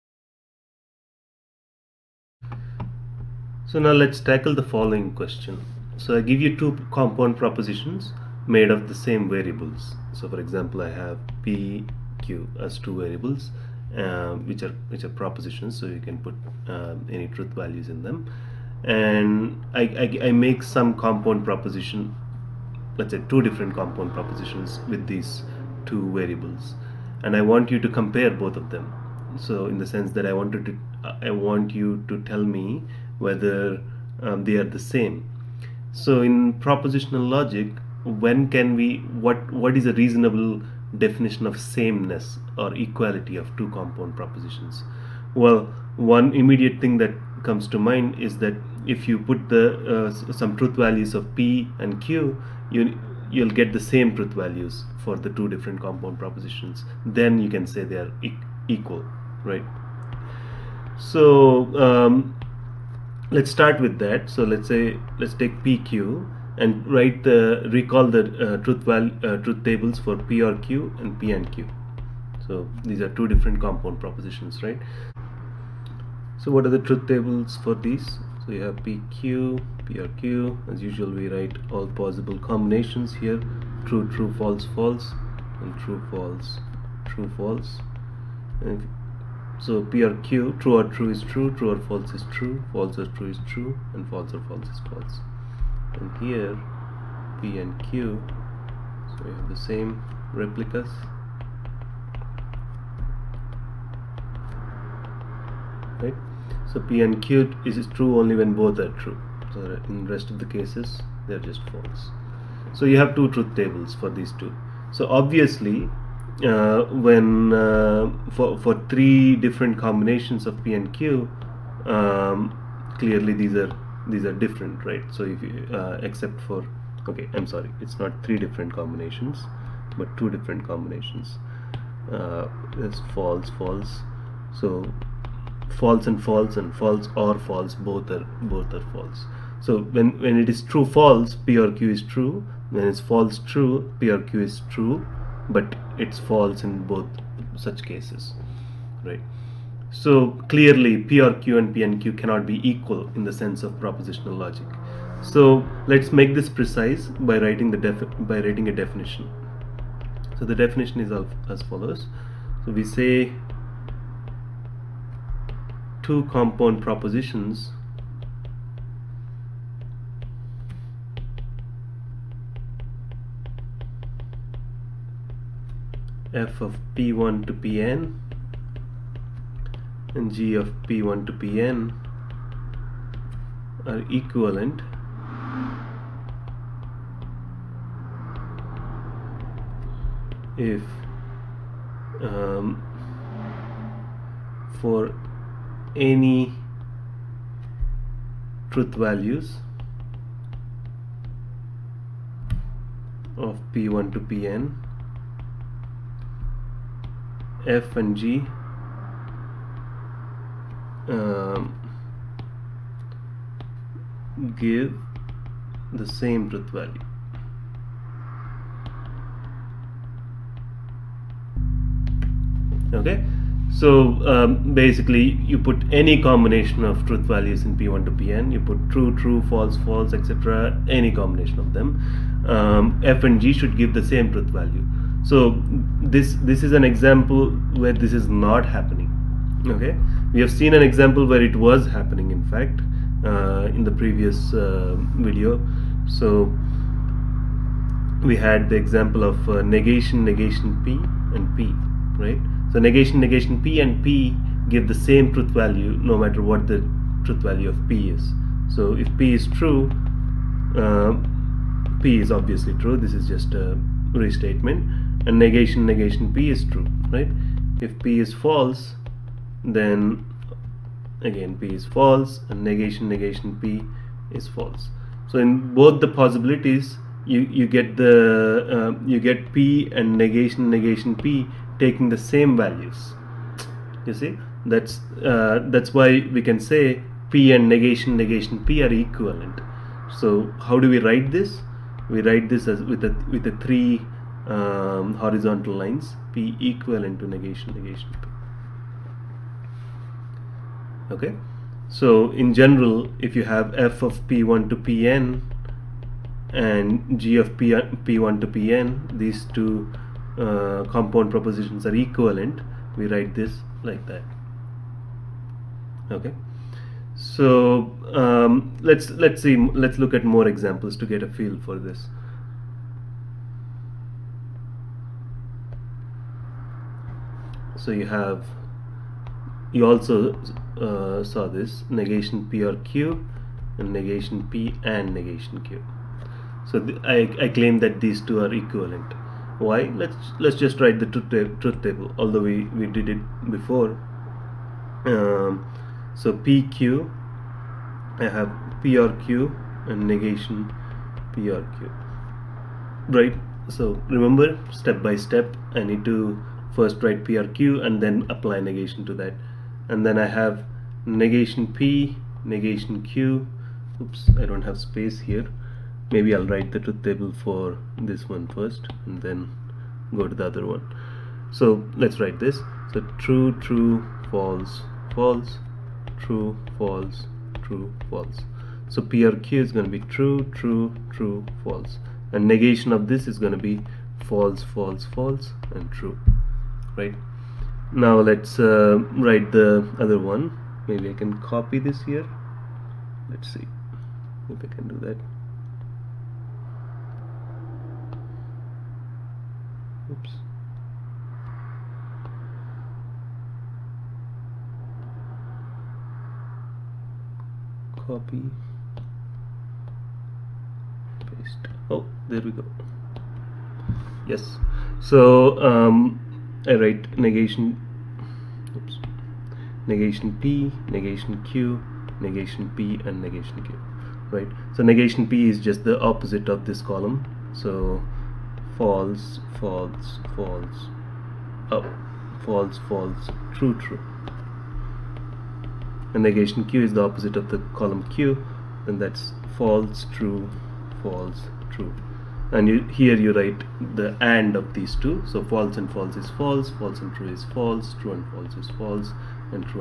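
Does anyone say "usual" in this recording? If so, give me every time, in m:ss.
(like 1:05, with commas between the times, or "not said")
1:20.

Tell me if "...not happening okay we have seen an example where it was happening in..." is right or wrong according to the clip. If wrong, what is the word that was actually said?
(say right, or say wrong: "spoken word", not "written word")
right.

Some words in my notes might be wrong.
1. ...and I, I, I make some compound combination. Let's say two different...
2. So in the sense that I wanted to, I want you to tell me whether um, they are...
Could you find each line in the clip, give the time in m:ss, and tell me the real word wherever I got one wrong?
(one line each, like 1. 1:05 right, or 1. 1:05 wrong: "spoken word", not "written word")
1. 0:18 wrong: "proposition", not "combination"
2. 0:29 right.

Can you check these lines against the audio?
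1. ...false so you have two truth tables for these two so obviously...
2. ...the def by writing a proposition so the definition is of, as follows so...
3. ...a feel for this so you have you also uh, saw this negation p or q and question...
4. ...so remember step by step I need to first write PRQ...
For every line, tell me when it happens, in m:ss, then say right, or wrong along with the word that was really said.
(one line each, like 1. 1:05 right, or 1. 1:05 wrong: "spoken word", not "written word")
1. 1:51 right
2. 2:37 wrong: "definition", not "proposition"
3. 5:21 wrong: "negation", not "question"
4. 5:53 right.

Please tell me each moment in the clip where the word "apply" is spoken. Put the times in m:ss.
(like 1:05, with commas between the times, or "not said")
5:58.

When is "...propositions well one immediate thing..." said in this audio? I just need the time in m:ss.
0:44.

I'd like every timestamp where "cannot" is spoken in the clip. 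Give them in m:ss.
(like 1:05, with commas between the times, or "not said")
2:32.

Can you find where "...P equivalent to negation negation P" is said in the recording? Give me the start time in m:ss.
4:56.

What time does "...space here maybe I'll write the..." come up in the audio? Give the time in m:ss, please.
6:04.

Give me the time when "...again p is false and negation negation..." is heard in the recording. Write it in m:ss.
4:31.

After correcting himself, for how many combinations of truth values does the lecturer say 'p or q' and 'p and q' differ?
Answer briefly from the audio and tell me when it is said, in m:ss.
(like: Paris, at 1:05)
2, at 2:10.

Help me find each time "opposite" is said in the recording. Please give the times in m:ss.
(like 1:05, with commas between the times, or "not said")
7:05, 7:17.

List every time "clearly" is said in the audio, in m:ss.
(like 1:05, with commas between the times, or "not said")
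2:02, 2:30.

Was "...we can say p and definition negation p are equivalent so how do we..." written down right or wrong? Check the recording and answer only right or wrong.
wrong.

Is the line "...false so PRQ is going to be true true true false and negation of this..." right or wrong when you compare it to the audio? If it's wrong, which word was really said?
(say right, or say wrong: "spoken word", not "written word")
right.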